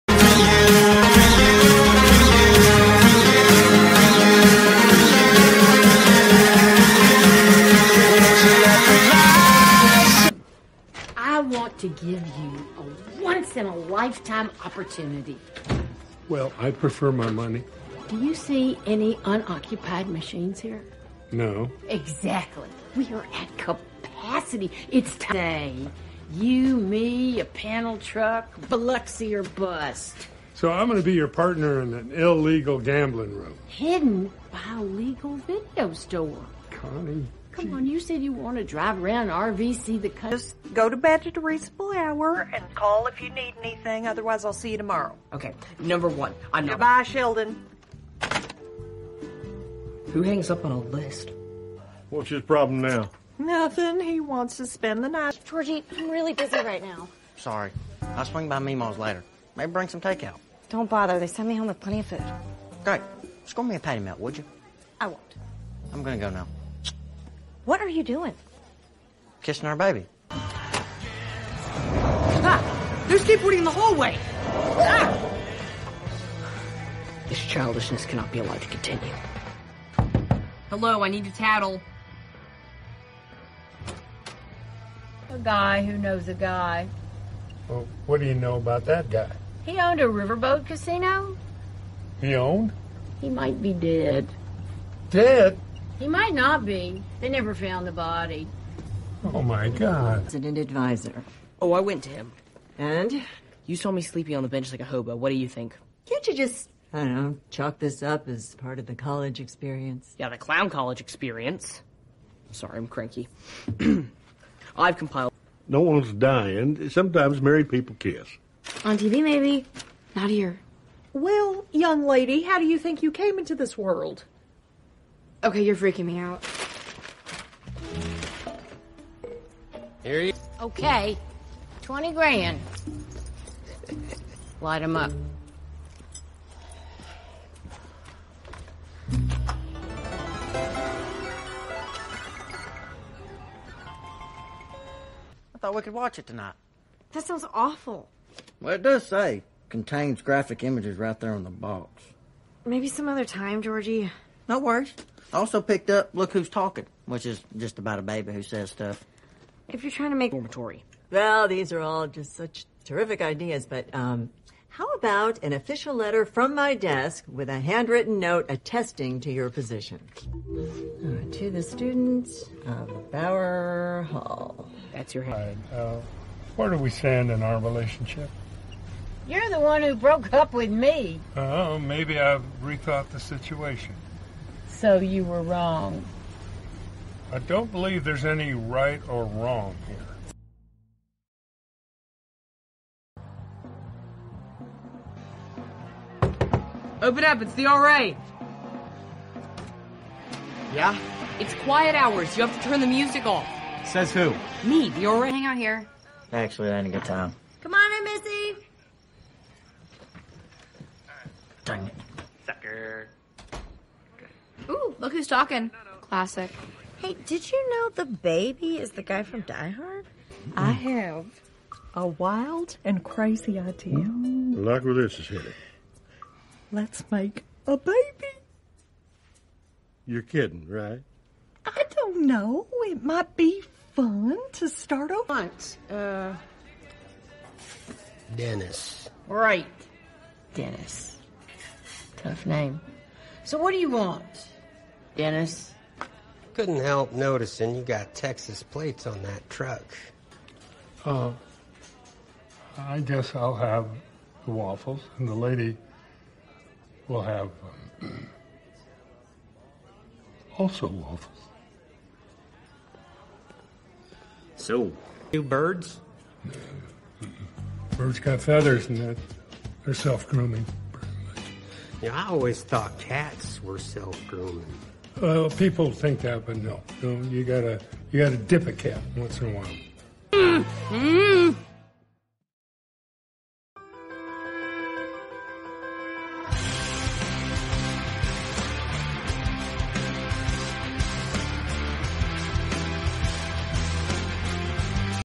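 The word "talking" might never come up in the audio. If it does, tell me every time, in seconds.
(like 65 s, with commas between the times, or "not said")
156 s, 215 s.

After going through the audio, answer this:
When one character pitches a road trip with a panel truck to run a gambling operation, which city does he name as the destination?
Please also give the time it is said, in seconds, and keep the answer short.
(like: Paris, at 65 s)
Biloxi, at 28 s.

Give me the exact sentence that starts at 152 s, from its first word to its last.
Maybe some other time, Georgie no worries.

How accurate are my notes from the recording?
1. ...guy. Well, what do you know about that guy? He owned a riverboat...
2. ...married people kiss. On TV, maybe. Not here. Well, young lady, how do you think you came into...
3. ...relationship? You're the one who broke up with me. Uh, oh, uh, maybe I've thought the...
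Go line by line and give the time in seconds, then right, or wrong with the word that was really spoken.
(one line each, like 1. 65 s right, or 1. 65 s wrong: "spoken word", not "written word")
1. 86 s right
2. 117 s right
3. 177 s wrong: "rethought", not "thought".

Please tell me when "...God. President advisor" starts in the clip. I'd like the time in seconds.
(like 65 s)
99 s.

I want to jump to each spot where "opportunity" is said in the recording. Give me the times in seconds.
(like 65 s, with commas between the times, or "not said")
14 s.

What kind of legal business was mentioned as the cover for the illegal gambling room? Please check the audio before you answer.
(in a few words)
video store.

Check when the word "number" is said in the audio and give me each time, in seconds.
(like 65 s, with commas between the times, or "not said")
45 s.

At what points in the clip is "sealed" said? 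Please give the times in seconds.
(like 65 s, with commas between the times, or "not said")
not said.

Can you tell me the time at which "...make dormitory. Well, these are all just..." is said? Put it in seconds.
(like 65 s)
160 s.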